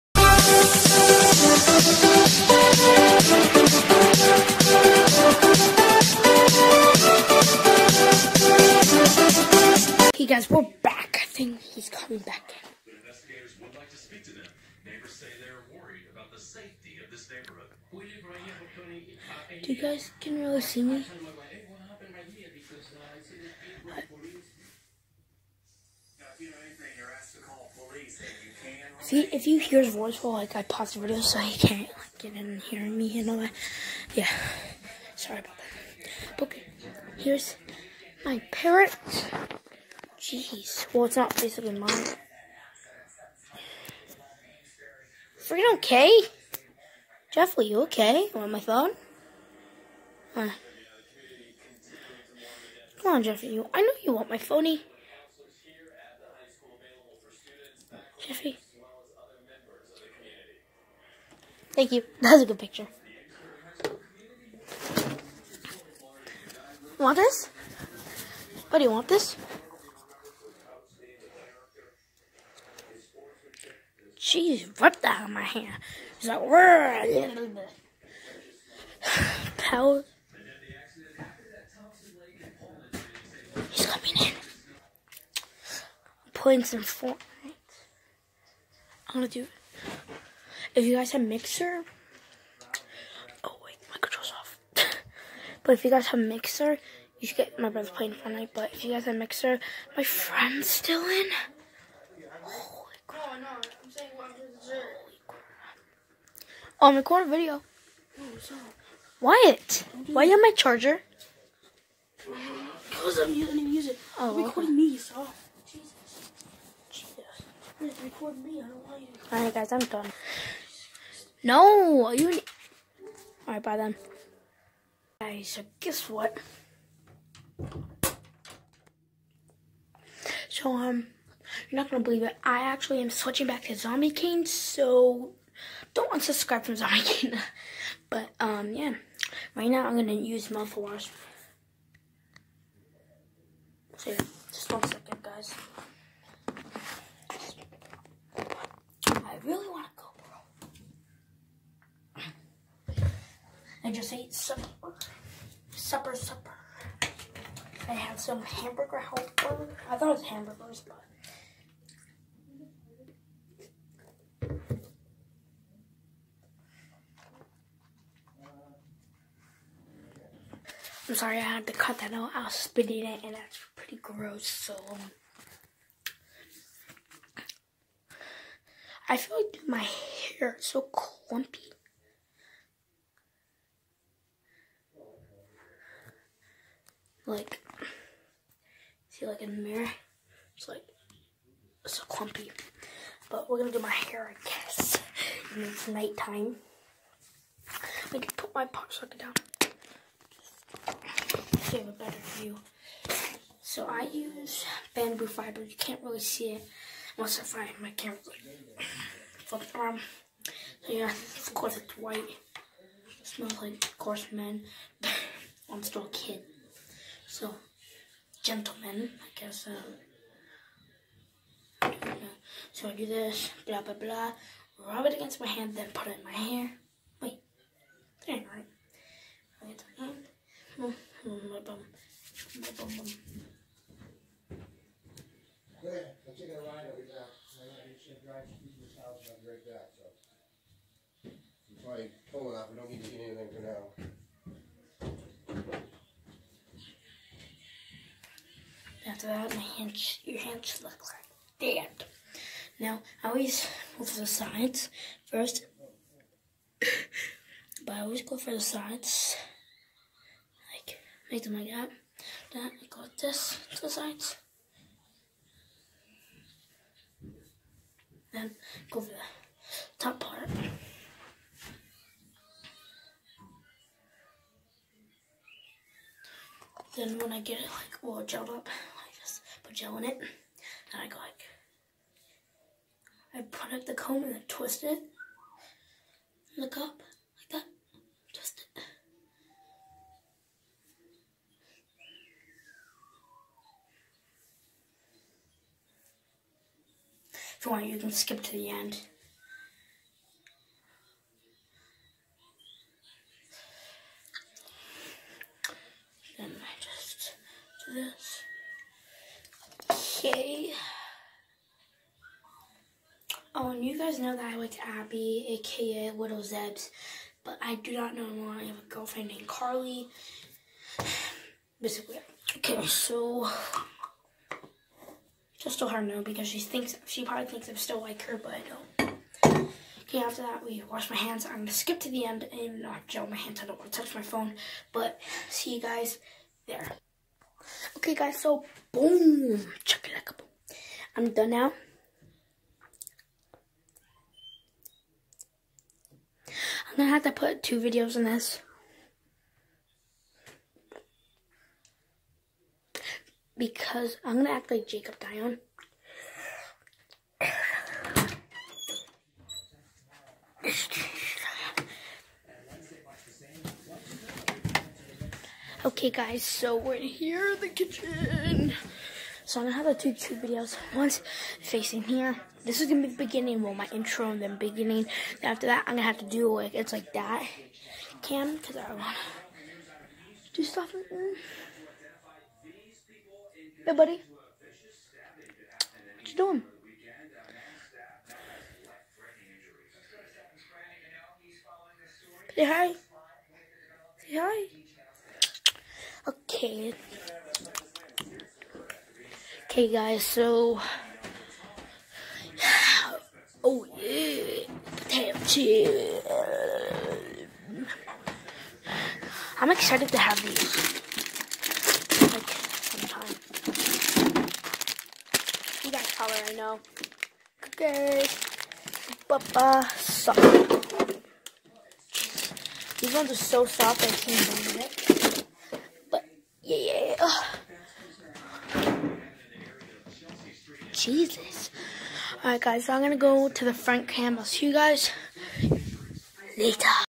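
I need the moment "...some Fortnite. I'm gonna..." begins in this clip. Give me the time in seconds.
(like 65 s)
86 s.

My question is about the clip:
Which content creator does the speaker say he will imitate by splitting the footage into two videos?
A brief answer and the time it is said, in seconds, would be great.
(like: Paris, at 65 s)
Jacob Dion, at 354 s.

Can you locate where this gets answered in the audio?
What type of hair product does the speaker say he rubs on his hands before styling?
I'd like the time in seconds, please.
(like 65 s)
204 s.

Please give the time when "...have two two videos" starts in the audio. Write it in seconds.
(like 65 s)
369 s.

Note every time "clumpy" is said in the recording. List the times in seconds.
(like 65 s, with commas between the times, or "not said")
180 s, 192 s.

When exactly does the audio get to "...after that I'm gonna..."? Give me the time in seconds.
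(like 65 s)
375 s.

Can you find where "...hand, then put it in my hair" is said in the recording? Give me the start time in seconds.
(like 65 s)
225 s.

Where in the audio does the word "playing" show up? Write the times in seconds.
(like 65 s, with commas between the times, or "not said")
86 s, 97 s.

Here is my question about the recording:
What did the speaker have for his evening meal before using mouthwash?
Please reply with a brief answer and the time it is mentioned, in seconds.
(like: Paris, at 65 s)
Hamburger Helper, at 158 s.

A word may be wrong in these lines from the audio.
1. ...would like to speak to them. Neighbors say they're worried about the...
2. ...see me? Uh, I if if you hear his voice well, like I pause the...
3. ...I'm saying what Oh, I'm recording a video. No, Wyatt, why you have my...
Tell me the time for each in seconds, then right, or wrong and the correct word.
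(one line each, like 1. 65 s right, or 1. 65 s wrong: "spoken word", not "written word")
1. 13 s right
2. 20 s right
3. 103 s right.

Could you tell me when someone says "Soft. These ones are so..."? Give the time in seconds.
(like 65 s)
419 s.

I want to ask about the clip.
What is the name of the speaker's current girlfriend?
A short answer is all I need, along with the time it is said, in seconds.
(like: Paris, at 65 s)
Carly, at 319 s.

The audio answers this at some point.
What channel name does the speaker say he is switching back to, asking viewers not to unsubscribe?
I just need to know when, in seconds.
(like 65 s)
133 s.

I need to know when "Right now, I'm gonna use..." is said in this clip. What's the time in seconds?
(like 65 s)
139 s.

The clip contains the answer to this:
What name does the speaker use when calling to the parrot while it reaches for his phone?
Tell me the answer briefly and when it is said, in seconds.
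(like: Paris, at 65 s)
Jeffrey, at 53 s.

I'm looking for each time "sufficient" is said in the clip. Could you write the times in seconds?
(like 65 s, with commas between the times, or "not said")
not said.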